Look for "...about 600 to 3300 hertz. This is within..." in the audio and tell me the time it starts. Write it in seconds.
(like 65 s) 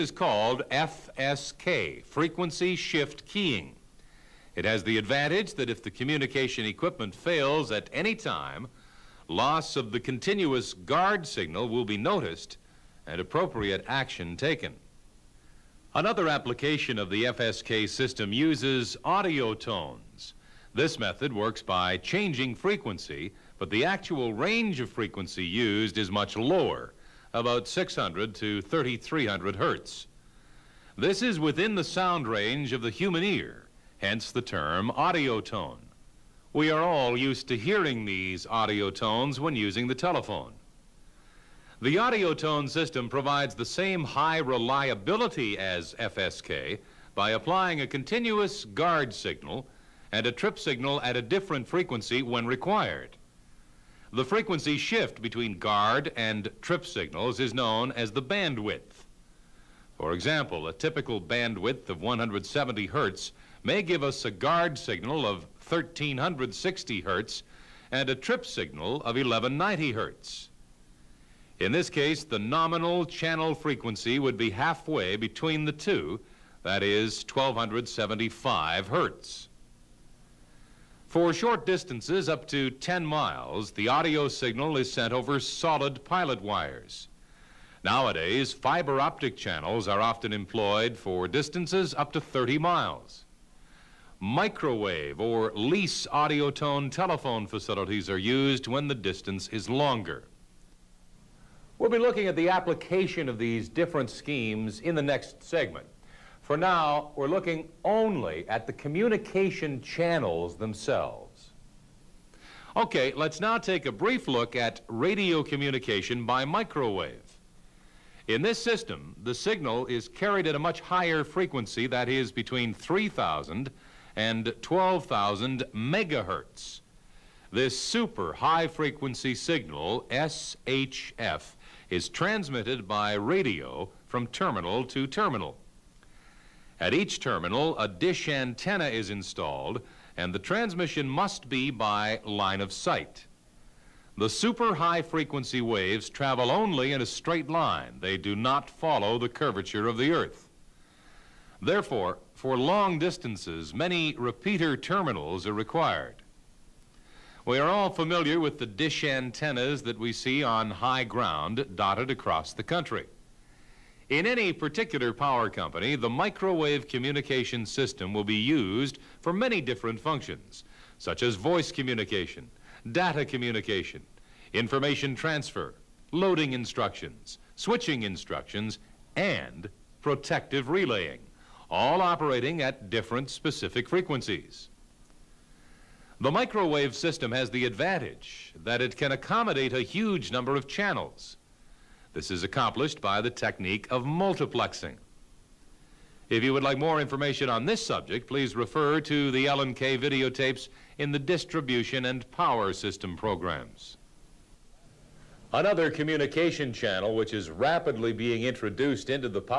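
27 s.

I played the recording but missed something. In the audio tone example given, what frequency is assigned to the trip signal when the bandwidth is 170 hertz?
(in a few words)
1190 hertz.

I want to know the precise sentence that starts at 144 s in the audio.
The super high frequency waves travel only in a straight line.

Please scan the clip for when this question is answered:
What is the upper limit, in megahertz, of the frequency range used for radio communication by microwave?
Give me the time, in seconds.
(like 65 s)
124 s.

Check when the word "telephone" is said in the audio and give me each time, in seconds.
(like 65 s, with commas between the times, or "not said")
39 s, 96 s.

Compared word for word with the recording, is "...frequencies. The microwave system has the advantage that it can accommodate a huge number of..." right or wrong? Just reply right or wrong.
right.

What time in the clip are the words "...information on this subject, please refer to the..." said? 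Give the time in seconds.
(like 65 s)
197 s.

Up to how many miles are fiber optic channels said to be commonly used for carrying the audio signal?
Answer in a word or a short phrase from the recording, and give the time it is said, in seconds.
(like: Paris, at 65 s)
30 miles, at 92 s.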